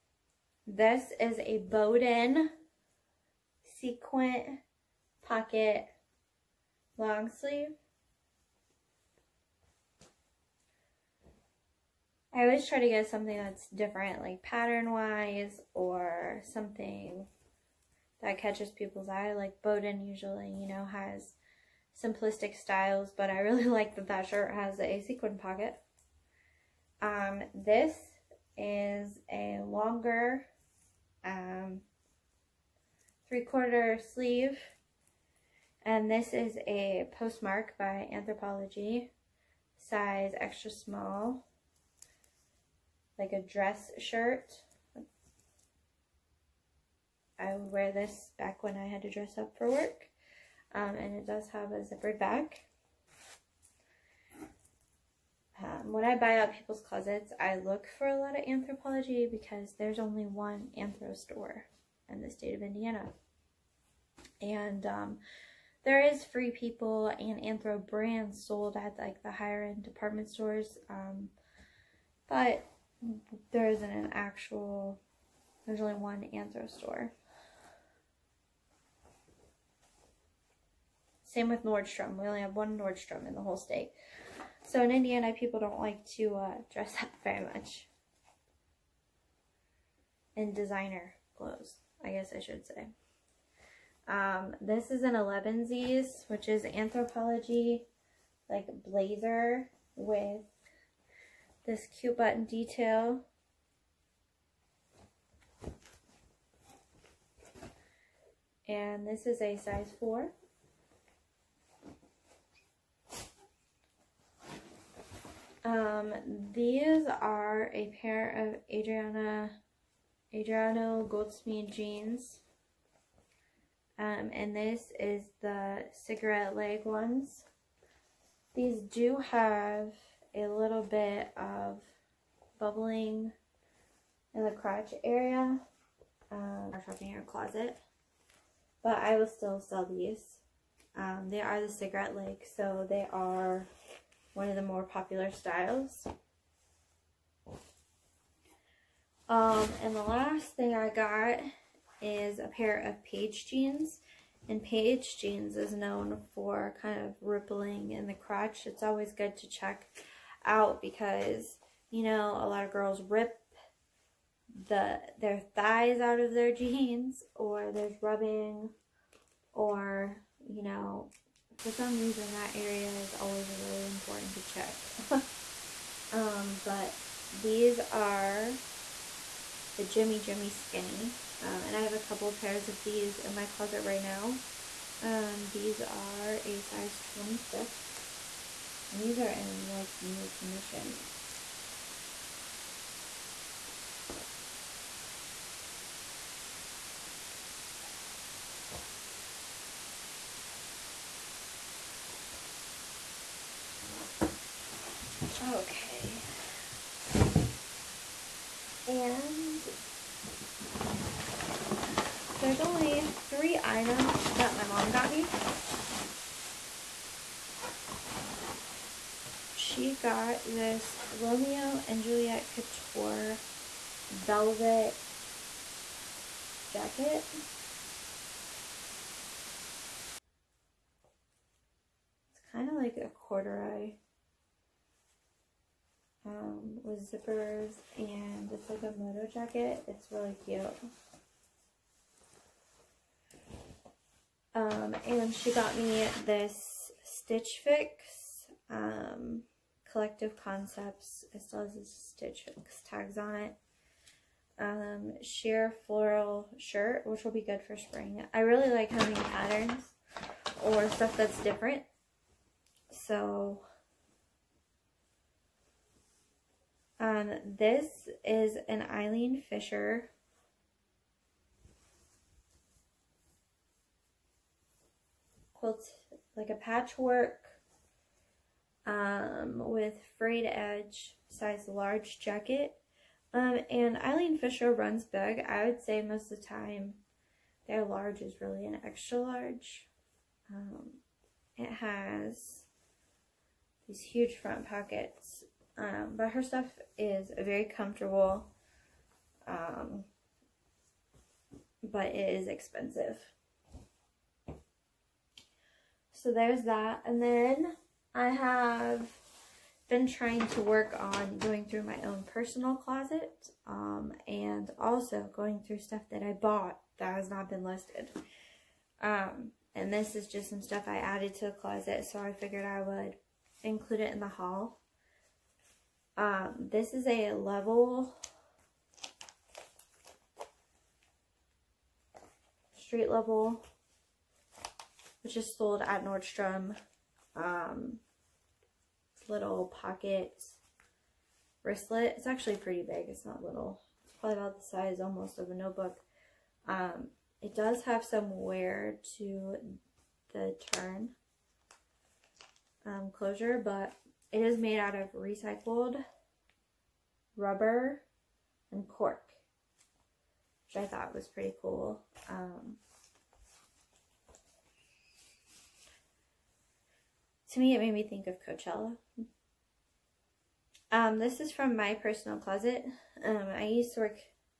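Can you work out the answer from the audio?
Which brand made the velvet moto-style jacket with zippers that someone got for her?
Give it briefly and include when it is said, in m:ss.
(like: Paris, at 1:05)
Romeo and Juliet Couture, at 3:41.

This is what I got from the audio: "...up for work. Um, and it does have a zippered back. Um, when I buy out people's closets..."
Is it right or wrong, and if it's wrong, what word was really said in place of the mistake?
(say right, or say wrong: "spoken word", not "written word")
right.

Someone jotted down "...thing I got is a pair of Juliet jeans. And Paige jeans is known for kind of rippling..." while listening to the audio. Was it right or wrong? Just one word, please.
wrong.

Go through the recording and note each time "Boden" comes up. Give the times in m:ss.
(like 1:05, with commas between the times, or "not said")
0:01, 0:19.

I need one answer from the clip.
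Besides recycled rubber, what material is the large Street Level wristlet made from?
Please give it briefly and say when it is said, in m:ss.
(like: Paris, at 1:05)
Cork, at 5:58.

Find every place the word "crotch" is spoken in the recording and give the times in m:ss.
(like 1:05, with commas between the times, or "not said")
2:14, 2:38.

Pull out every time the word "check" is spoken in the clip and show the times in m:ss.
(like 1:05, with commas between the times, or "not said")
2:39, 2:54.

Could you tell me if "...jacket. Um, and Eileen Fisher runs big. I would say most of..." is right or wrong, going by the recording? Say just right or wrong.
right.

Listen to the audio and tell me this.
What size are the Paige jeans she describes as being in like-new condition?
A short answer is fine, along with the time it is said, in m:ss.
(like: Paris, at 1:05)
26, at 3:06.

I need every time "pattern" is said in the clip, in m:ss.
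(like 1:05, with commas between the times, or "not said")
0:14, 4:19.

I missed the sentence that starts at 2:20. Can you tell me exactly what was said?
Um, they are the cigarette legs so they are one of the more popular styles.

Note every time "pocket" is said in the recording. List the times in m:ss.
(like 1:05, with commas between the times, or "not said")
0:05, 0:25, 4:54, 5:39.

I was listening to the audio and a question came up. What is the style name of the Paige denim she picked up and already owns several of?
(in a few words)
Jimmy Jimmy Skinny.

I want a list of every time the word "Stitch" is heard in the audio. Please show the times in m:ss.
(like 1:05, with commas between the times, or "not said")
4:07, 4:11.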